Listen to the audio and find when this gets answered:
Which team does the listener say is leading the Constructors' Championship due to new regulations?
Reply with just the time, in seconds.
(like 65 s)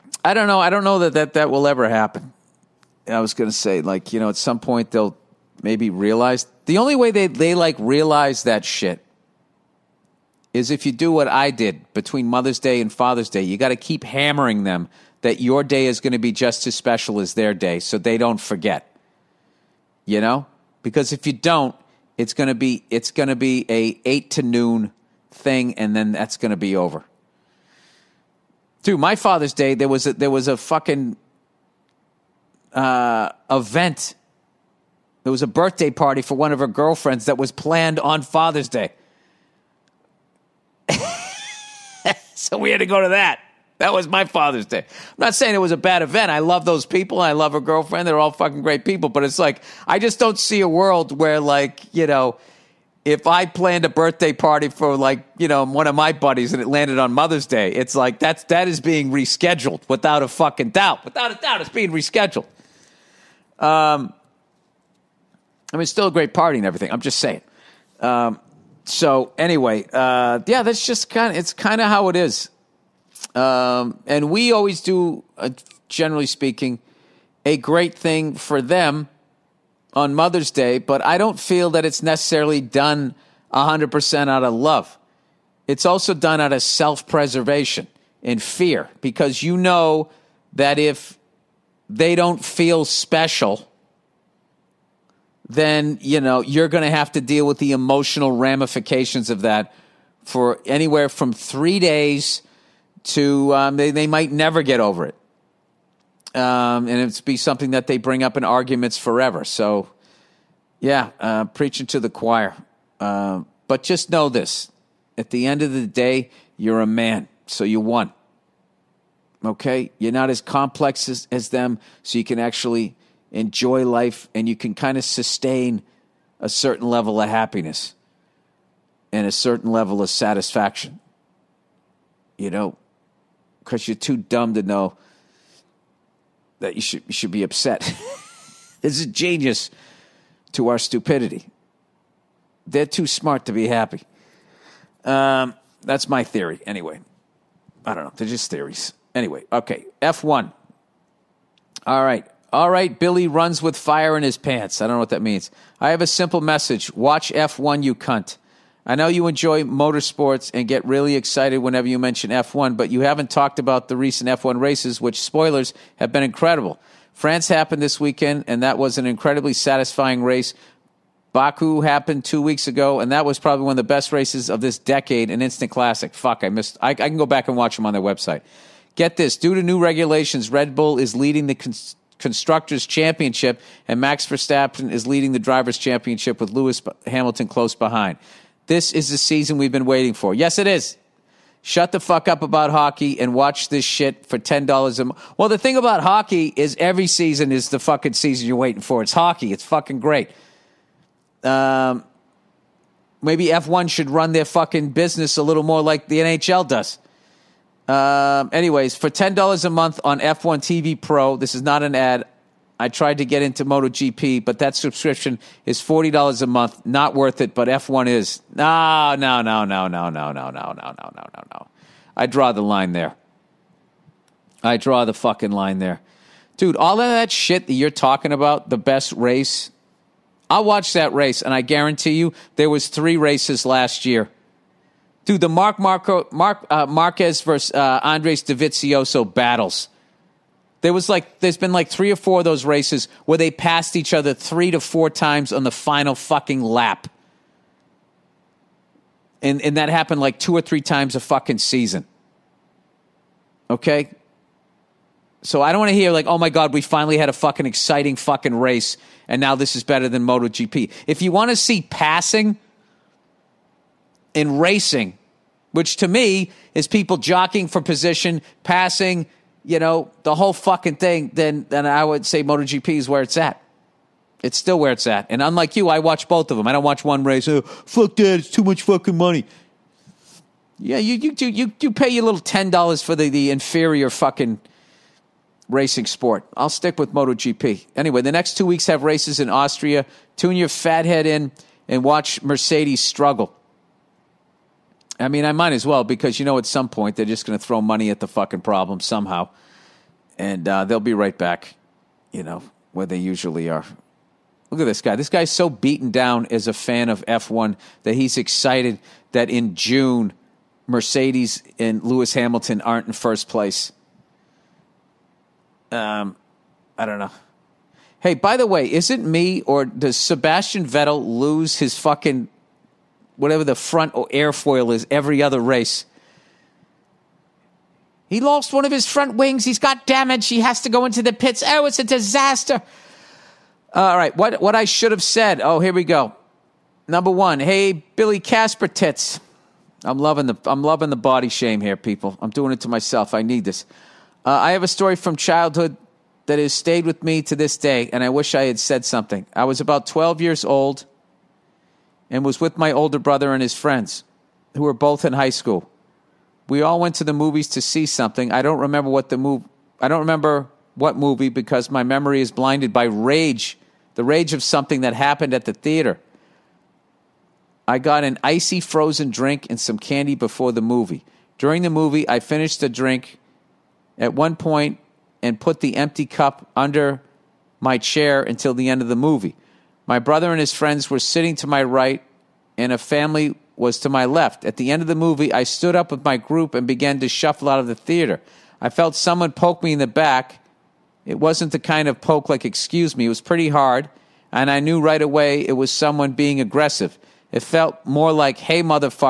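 180 s.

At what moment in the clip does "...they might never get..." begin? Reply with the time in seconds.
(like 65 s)
103 s.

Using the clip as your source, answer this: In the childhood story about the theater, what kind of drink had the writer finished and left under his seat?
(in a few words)
Icy frozen drink.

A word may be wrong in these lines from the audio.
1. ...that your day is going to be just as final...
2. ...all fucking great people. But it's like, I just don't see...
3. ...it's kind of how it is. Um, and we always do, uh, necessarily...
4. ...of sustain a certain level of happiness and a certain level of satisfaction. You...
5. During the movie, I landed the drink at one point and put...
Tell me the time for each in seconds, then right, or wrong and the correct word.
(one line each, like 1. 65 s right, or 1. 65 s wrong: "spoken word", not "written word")
1. 15 s wrong: "special", not "final"
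2. 48 s right
3. 71 s wrong: "generally", not "necessarily"
4. 124 s right
5. 371 s wrong: "finished", not "landed".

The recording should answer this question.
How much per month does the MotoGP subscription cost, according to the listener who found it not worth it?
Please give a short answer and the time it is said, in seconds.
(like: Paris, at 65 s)
$40, at 215 s.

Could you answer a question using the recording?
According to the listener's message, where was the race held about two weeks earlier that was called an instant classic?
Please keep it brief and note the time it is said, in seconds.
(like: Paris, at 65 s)
Baku, at 171 s.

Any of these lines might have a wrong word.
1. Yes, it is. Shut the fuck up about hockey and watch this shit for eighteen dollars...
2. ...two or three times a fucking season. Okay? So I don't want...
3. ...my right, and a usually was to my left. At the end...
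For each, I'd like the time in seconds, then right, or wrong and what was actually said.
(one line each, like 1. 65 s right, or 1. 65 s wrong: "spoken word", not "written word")
1. 190 s wrong: "ten", not "eighteen"
2. 250 s right
3. 381 s wrong: "family", not "usually".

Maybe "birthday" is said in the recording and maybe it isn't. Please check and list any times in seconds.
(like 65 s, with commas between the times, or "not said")
35 s, 53 s.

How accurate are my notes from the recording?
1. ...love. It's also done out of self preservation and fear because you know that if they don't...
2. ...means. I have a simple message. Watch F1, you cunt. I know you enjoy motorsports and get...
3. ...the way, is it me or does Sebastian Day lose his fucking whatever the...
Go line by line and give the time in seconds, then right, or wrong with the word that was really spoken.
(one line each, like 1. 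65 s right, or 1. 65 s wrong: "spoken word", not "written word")
1. 84 s right
2. 155 s right
3. 318 s wrong: "Vettel", not "Day".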